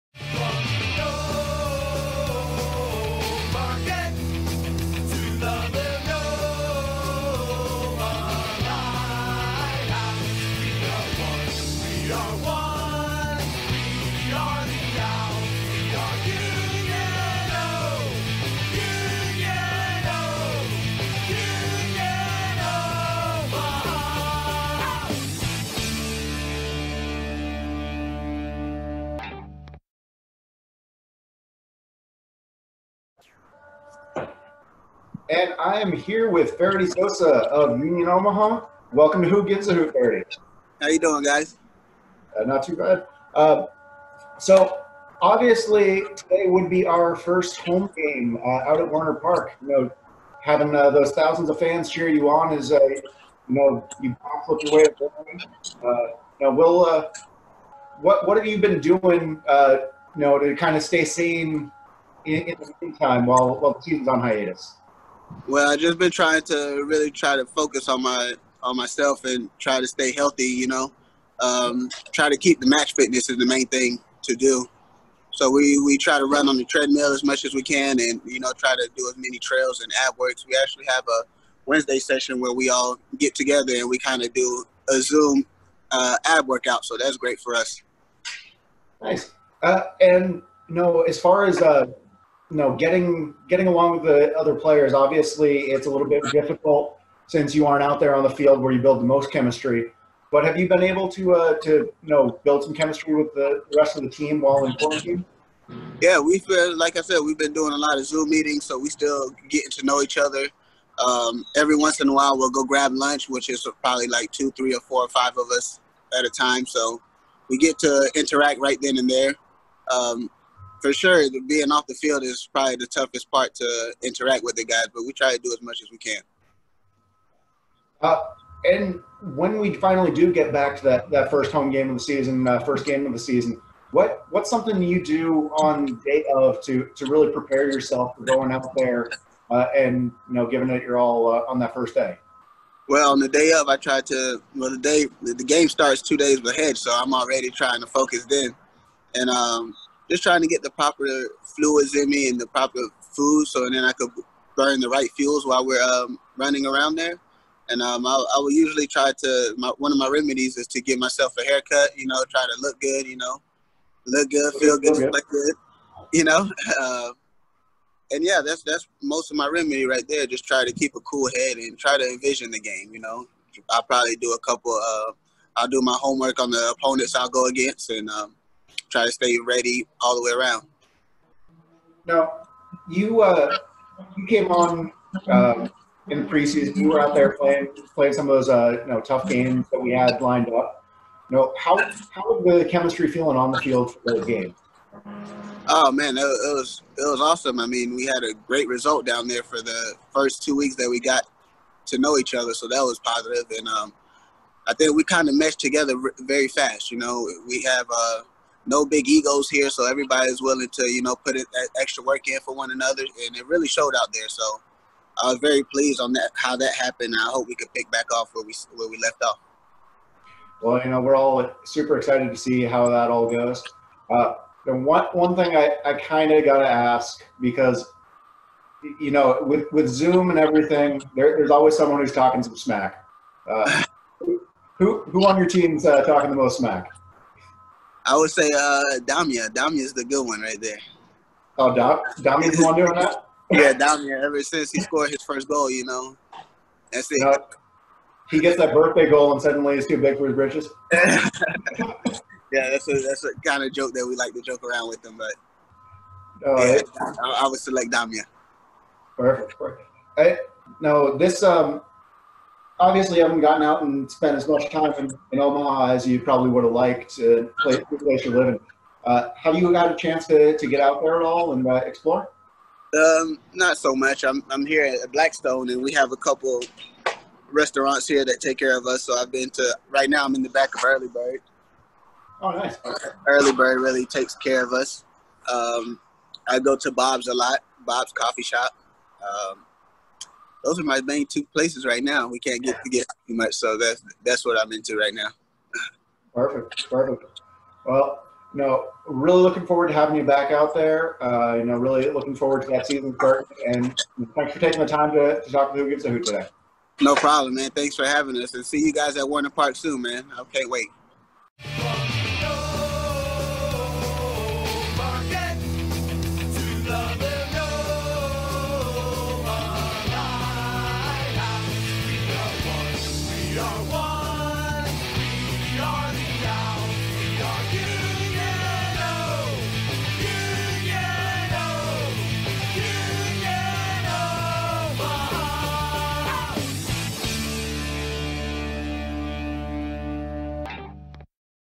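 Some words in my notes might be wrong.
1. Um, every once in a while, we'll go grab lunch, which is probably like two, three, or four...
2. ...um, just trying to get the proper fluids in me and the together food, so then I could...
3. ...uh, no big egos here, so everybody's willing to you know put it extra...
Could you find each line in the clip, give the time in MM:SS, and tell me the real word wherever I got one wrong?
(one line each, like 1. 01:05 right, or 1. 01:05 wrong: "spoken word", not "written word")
1. 01:51 right
2. 02:29 wrong: "proper", not "together"
3. 03:27 right.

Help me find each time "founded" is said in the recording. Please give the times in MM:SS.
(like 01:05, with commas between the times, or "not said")
not said.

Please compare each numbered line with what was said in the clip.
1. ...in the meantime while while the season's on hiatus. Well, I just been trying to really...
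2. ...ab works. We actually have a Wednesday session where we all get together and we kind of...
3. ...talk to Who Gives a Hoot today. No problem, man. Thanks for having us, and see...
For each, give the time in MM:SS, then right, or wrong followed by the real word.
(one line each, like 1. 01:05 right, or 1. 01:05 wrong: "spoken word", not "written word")
1. 01:02 right
2. 01:20 right
3. 05:05 right.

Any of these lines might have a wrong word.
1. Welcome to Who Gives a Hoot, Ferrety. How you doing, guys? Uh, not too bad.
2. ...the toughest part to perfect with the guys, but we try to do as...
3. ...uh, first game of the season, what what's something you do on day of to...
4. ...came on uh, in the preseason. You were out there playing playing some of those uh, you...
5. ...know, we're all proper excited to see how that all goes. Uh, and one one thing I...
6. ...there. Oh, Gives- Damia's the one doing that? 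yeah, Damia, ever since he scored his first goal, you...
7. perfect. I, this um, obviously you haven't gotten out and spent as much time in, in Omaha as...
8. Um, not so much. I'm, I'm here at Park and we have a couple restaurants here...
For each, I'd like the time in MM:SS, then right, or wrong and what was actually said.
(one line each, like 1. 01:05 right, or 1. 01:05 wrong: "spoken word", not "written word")
1. 00:38 right
2. 02:02 wrong: "interact", not "perfect"
3. 02:12 right
4. 03:04 right
5. 03:40 wrong: "super", not "proper"
6. 04:00 wrong: "Dam", not "Gives"
7. 04:19 right
8. 04:32 wrong: "Blackstone", not "Park".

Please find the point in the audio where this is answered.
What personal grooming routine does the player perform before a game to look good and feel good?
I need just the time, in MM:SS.
02:40.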